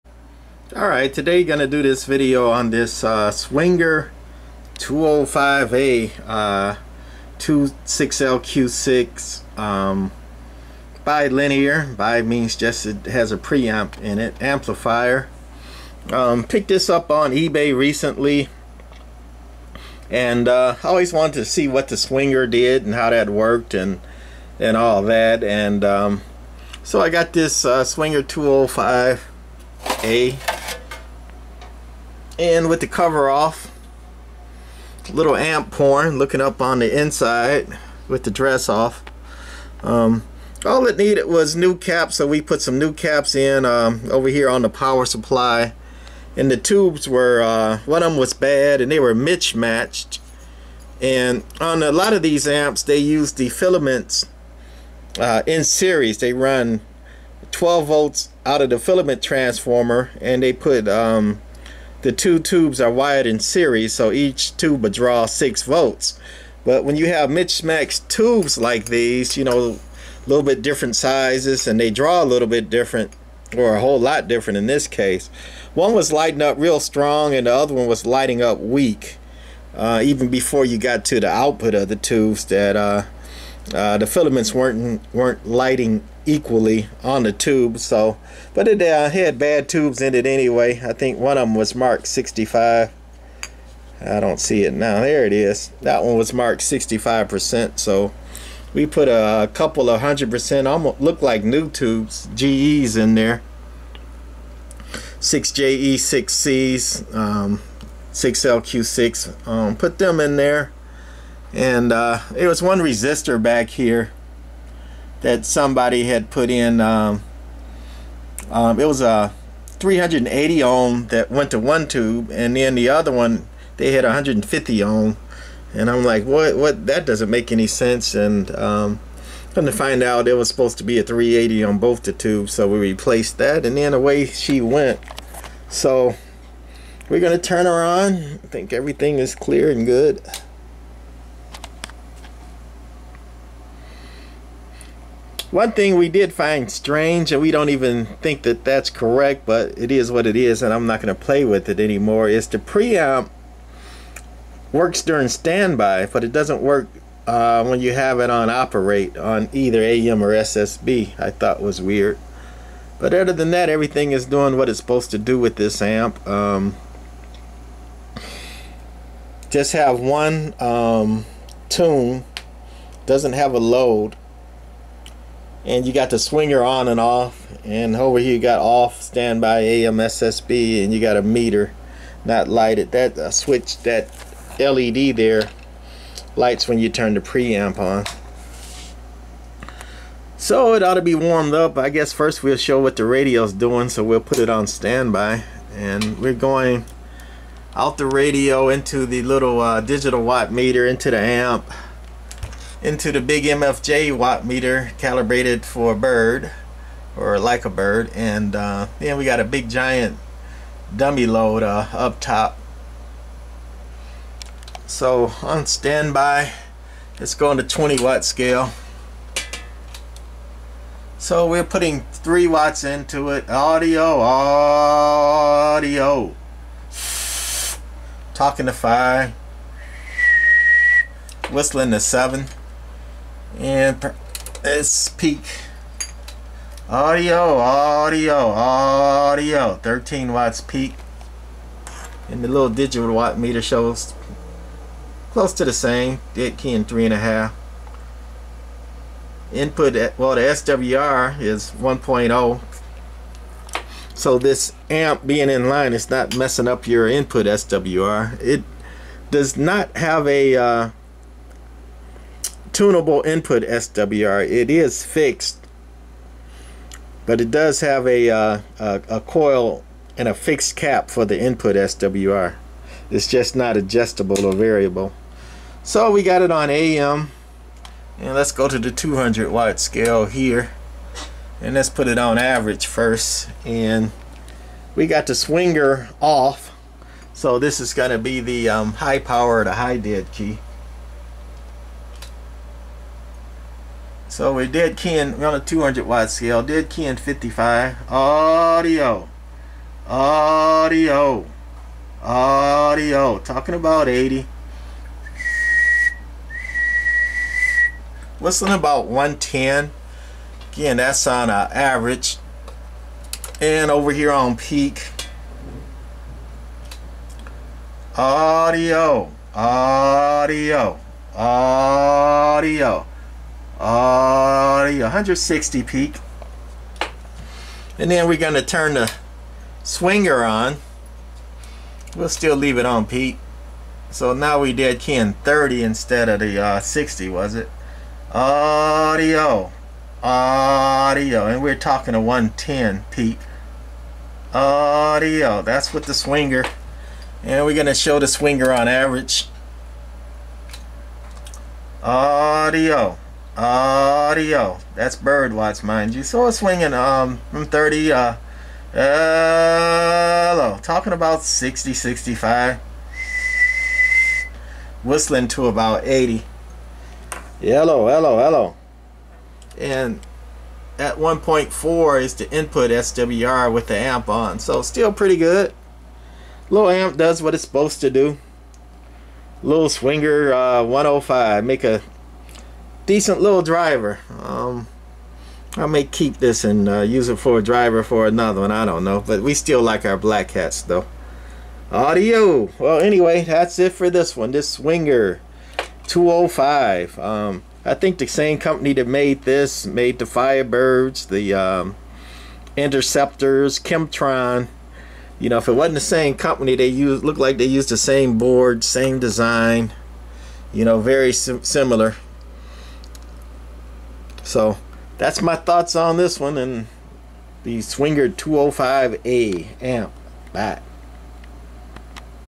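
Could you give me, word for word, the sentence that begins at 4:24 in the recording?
It is fixed, but it does have a, uh, a, a coil and a fixed cap for the input SWR.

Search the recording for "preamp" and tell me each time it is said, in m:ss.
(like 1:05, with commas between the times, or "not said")
0:13, 2:32, 3:07.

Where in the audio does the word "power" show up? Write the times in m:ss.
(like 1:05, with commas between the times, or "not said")
0:44, 4:49.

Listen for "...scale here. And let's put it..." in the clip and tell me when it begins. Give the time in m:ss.
4:39.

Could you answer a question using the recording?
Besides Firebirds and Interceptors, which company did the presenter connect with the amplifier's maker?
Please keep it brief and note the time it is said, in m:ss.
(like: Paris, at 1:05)
Kemtron, at 6:43.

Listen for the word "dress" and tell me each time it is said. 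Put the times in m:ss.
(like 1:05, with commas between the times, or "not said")
0:38.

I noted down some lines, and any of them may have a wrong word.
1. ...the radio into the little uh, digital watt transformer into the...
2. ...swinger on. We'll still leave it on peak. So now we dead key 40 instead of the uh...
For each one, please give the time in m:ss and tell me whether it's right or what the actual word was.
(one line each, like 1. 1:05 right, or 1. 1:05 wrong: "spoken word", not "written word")
1. 3:17 wrong: "meter", not "transformer"
2. 5:29 wrong: "30", not "40".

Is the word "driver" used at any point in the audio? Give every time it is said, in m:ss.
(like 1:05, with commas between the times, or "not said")
6:23, 6:27.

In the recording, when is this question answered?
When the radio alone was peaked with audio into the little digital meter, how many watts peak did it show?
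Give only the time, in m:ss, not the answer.
3:59.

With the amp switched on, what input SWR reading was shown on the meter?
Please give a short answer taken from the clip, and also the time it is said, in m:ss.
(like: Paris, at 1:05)
1.4, at 6:11.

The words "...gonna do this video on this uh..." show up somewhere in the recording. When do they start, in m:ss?
0:01.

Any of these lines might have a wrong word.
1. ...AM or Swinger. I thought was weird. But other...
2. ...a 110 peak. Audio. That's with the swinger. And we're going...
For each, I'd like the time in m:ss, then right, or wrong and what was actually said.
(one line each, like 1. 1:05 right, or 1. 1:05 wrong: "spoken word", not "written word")
1. 2:39 wrong: "SSB", not "Swinger"
2. 5:42 right.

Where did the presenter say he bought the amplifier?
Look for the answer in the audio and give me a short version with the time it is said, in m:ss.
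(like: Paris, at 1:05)
eBay, at 0:17.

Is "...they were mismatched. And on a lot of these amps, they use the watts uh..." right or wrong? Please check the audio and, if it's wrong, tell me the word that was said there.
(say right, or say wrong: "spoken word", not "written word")
wrong: "filaments", not "watts".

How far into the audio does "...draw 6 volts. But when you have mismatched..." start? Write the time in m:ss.
1:04.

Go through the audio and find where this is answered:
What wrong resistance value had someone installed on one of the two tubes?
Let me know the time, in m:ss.
2:04.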